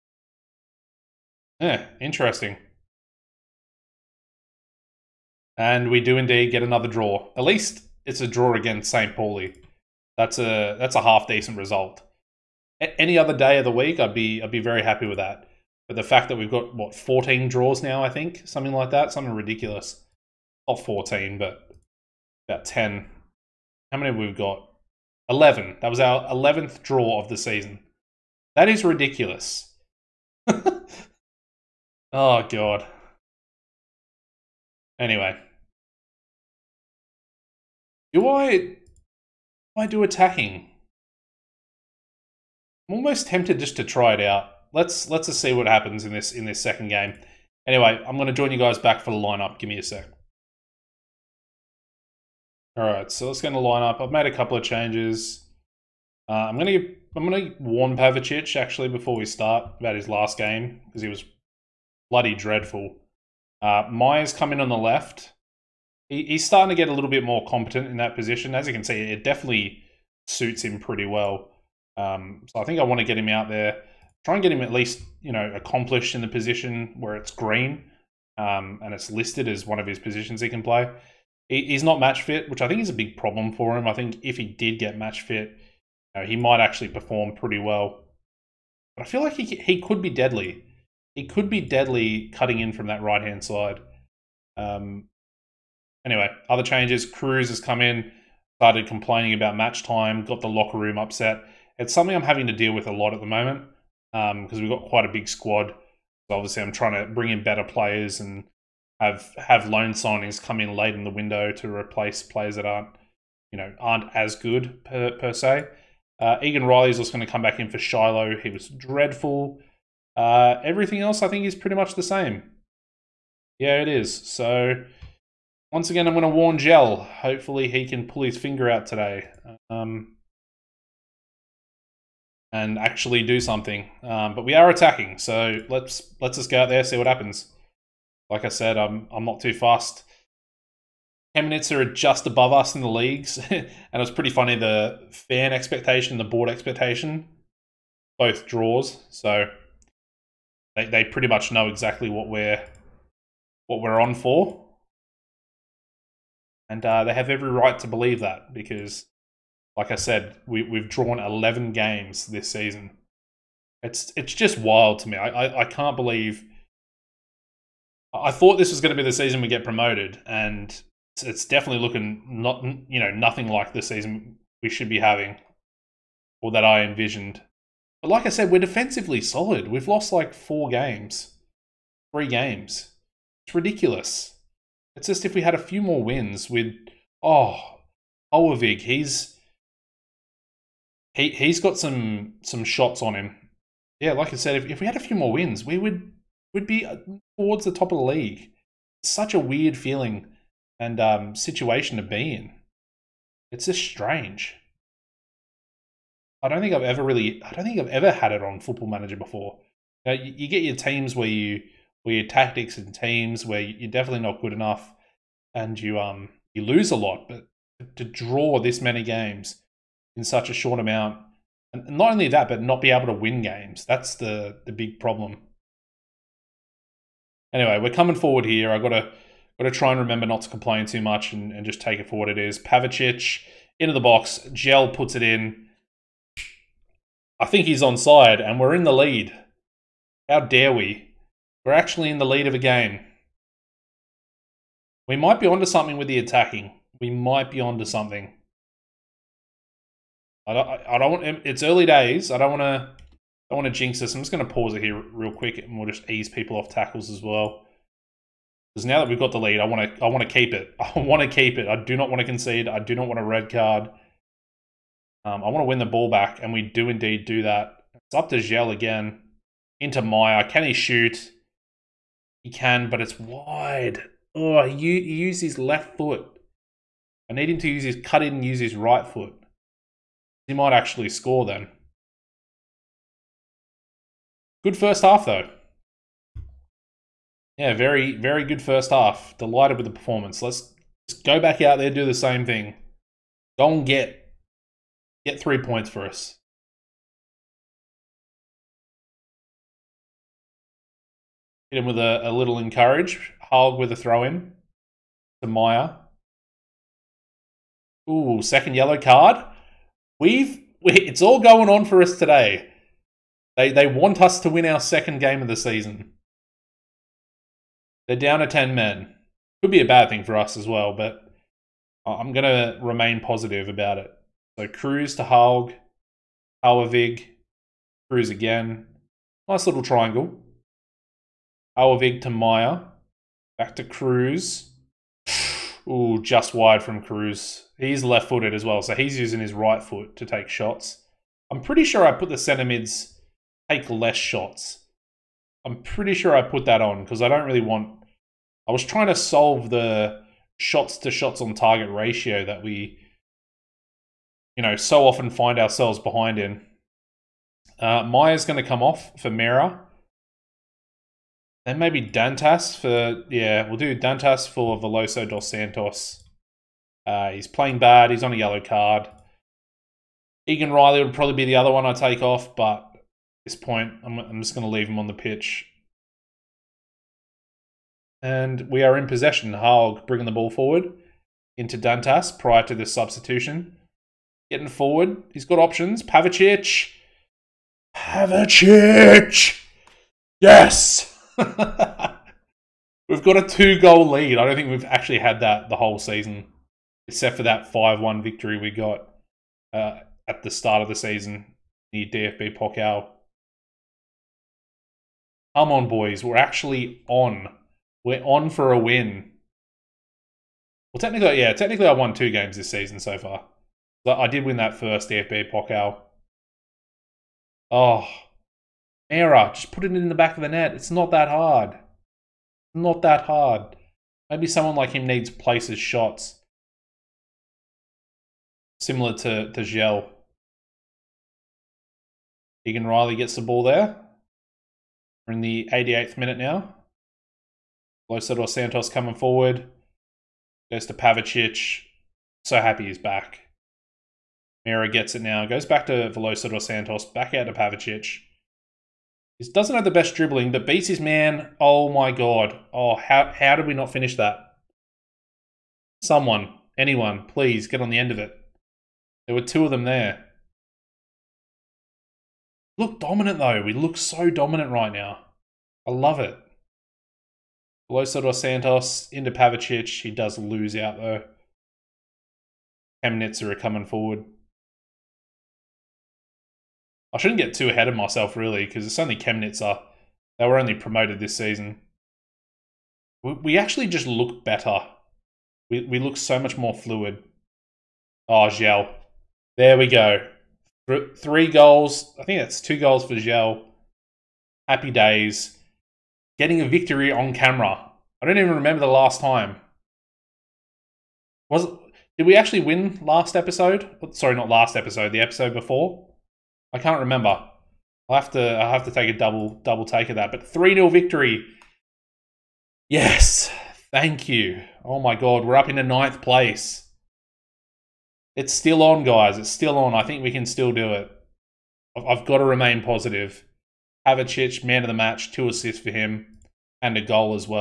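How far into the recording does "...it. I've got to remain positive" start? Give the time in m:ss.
8:40.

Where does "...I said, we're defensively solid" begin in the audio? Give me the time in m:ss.
2:58.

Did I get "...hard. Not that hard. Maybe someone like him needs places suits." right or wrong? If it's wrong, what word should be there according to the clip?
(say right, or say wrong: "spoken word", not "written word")
wrong: "shots", not "suits".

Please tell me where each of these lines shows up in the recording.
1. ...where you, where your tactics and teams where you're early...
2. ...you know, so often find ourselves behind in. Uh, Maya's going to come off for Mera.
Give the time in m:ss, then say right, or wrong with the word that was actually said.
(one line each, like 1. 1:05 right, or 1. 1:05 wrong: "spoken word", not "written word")
1. 3:31 wrong: "definitely", not "early"
2. 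5:54 right.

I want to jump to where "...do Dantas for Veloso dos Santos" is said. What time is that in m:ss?
6:03.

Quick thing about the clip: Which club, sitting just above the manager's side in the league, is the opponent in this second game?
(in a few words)
Chemnitz.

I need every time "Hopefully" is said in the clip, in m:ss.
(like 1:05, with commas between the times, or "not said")
2:06.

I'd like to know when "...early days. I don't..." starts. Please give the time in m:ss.
4:11.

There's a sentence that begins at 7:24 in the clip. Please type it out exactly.
Mira gets it now, goes back to dos Santos, back out to Pavicic.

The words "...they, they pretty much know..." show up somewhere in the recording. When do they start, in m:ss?
2:30.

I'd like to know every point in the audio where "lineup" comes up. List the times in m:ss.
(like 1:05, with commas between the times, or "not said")
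0:49, 0:53.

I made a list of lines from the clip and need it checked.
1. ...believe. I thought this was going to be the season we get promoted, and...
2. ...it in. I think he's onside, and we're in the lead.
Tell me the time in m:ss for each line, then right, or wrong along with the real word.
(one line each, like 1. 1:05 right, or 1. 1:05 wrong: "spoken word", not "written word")
1. 2:45 right
2. 3:55 right.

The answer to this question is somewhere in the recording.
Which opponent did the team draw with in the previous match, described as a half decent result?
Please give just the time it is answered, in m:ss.
0:08.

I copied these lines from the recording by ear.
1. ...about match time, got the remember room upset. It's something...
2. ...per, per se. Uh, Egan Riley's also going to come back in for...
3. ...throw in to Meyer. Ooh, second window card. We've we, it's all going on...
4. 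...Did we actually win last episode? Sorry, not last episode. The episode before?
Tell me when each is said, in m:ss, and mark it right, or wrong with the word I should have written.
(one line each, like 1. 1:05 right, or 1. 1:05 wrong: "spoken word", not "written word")
1. 1:39 wrong: "locker", not "remember"
2. 1:54 right
3. 5:03 wrong: "yellow", not "window"
4. 8:22 right.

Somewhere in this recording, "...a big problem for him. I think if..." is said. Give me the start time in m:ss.
1:22.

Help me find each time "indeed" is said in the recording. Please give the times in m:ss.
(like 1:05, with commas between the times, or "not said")
0:06, 4:26.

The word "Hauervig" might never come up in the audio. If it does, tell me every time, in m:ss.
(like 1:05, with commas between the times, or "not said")
5:26, 5:31.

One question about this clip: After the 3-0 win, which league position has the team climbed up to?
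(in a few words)
9th.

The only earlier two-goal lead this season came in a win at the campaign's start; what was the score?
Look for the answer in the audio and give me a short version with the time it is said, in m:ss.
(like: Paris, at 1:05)
5-1, at 6:37.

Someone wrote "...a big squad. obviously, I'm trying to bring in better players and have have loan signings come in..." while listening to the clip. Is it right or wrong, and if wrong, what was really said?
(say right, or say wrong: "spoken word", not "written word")
right.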